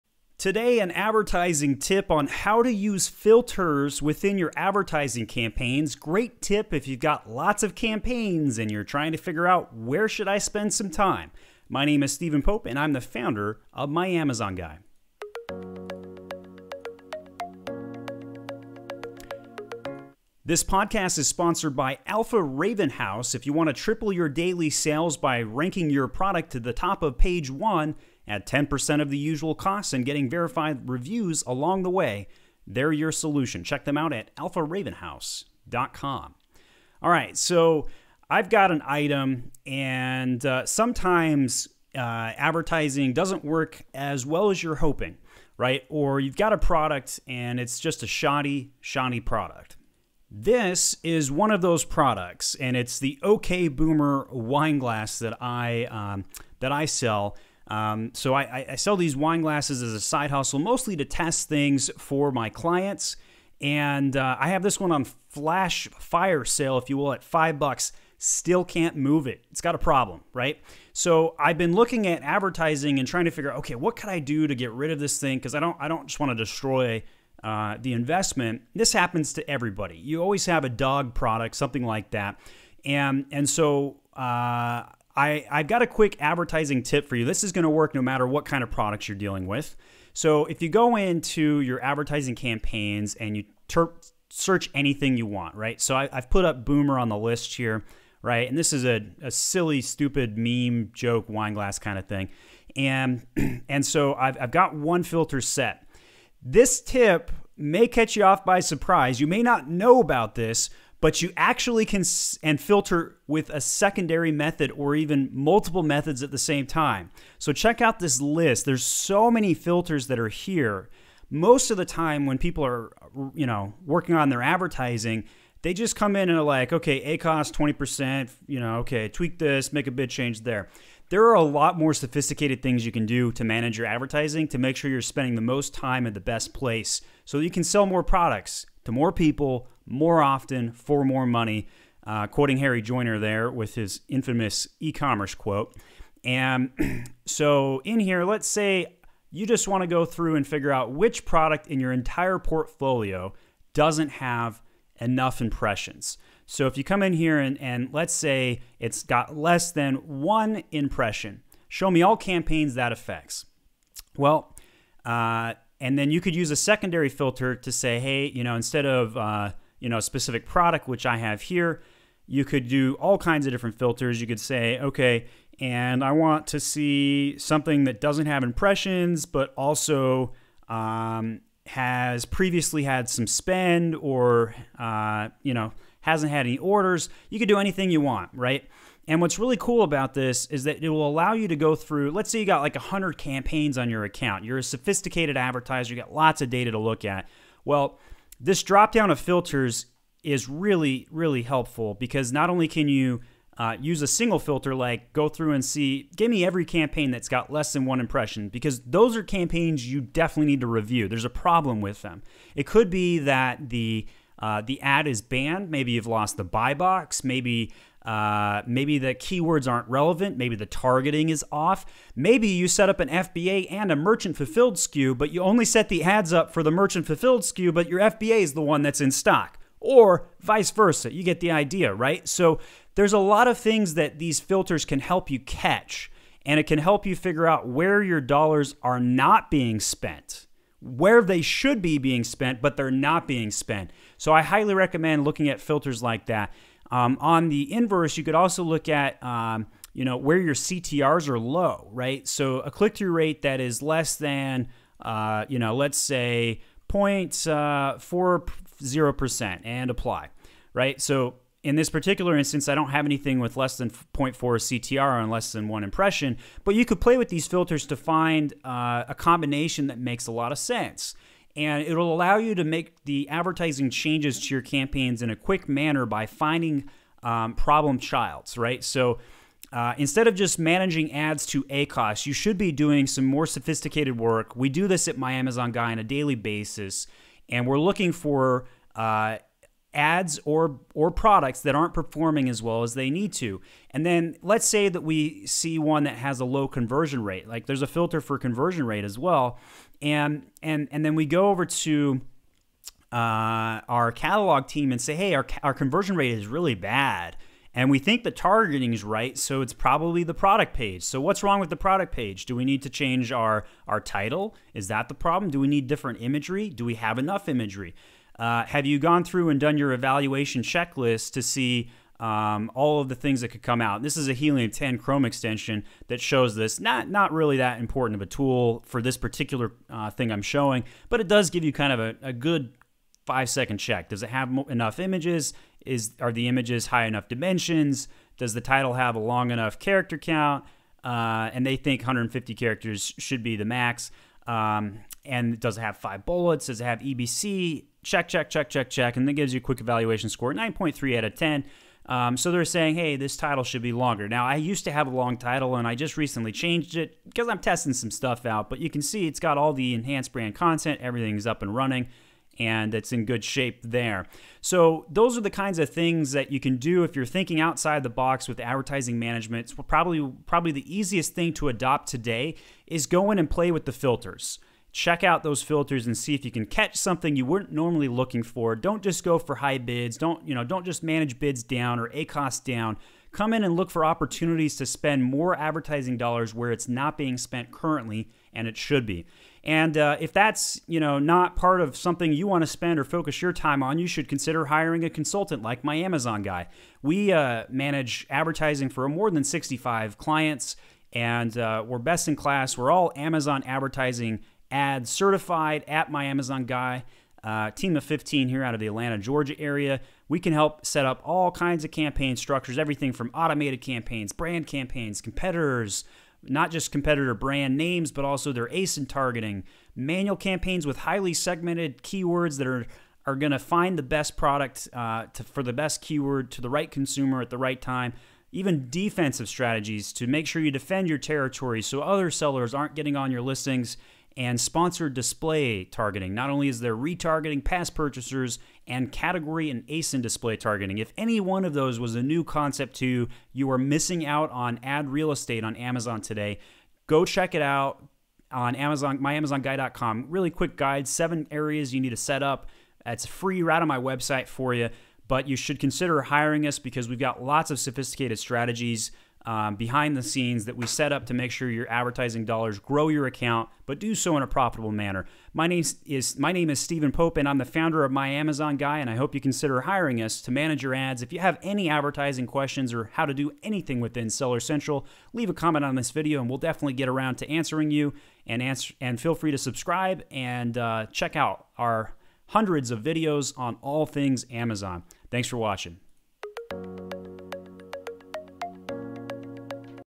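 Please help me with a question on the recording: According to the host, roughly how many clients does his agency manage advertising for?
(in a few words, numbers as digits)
More than 65.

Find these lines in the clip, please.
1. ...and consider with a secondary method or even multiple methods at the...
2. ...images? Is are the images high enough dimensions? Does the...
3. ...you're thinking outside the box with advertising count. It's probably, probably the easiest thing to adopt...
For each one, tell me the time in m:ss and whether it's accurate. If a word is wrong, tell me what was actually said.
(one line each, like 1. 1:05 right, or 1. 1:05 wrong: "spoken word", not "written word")
1. 1:52 wrong: "filter", not "consider"
2. 5:34 right
3. 6:07 wrong: "management", not "count".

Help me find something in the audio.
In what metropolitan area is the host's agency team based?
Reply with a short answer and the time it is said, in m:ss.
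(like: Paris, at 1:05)
Atlanta, Georgia, at 6:48.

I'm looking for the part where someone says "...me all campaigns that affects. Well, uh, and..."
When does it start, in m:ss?
2:41.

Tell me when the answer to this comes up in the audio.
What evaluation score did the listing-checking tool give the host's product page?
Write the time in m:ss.
5:50.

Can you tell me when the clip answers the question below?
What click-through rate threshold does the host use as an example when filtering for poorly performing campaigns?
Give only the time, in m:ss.
4:17.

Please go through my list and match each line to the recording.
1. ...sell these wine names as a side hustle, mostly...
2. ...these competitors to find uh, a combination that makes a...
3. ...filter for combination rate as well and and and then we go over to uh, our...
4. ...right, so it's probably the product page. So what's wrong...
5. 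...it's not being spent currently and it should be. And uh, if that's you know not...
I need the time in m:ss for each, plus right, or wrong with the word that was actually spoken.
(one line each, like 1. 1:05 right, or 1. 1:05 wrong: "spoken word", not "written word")
1. 0:58 wrong: "glasses", not "names"
2. 4:27 wrong: "filters", not "competitors"
3. 4:57 wrong: "conversion", not "combination"
4. 5:09 right
5. 6:26 right.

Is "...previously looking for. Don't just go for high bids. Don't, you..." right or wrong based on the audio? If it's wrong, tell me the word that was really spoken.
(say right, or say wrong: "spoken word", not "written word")
wrong: "normally", not "previously".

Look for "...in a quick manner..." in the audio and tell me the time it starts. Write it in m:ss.
4:35.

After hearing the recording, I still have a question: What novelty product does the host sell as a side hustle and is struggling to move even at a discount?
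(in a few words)
OK Boomer wine glass.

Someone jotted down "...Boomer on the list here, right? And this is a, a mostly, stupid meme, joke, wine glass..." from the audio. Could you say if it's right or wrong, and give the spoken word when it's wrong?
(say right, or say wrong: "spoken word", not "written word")
wrong: "silly", not "mostly".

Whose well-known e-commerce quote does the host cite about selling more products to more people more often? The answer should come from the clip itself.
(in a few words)
Harry Joyner.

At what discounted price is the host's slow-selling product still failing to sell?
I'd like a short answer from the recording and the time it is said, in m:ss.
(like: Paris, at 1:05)
$5, at 1:07.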